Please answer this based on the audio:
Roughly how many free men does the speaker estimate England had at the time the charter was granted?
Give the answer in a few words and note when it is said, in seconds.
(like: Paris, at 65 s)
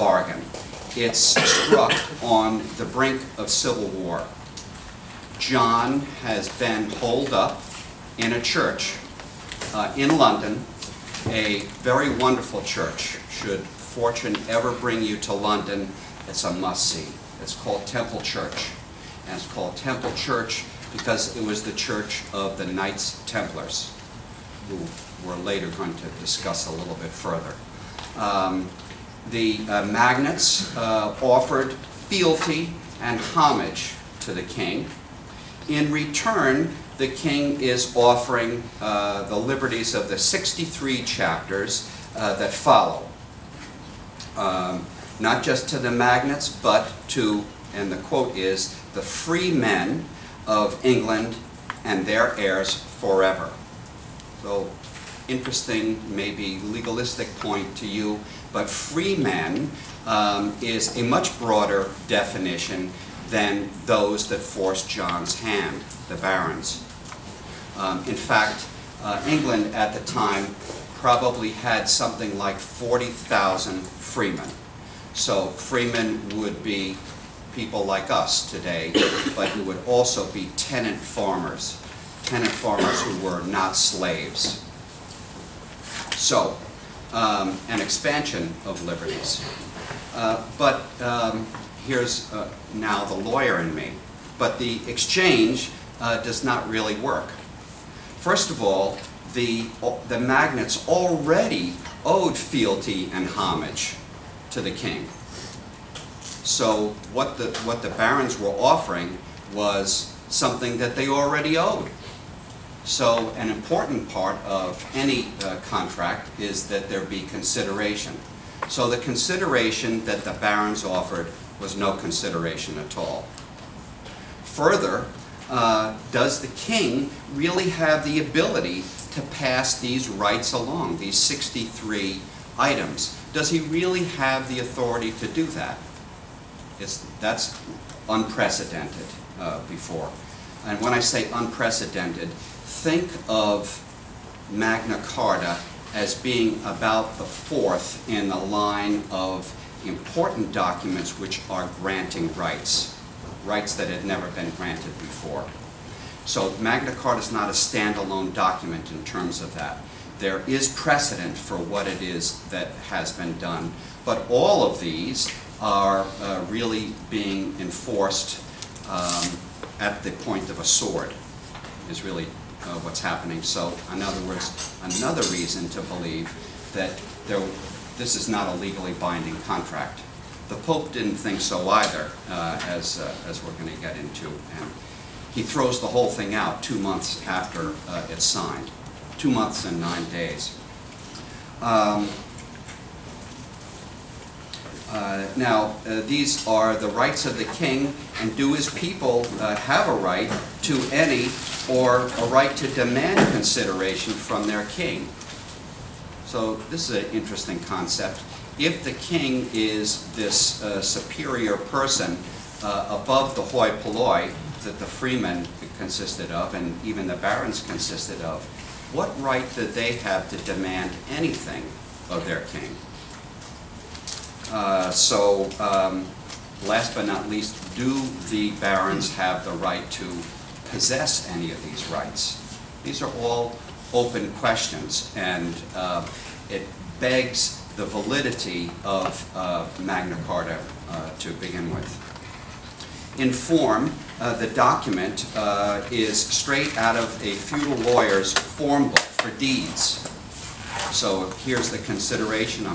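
40,000, at 72 s.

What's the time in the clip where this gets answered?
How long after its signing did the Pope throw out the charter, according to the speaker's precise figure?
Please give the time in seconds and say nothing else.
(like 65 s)
189 s.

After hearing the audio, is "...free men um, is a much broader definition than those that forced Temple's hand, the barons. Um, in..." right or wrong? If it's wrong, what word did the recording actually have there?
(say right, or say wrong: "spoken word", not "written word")
wrong: "John", not "Temple".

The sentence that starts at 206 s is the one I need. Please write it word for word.
So this is an interesting concept.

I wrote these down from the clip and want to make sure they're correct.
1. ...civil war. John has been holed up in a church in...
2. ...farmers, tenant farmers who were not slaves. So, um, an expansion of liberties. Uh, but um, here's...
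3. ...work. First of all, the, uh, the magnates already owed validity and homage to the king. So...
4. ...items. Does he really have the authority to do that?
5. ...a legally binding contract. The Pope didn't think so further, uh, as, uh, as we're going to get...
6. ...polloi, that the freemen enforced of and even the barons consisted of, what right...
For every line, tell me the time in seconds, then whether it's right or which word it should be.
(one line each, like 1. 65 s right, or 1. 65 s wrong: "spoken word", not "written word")
1. 3 s right
2. 80 s right
3. 96 s wrong: "fealty", not "validity"
4. 132 s right
5. 178 s wrong: "either", not "further"
6. 213 s wrong: "consisted", not "enforced".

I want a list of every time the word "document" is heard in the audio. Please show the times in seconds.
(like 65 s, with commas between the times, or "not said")
150 s, 158 s, 244 s.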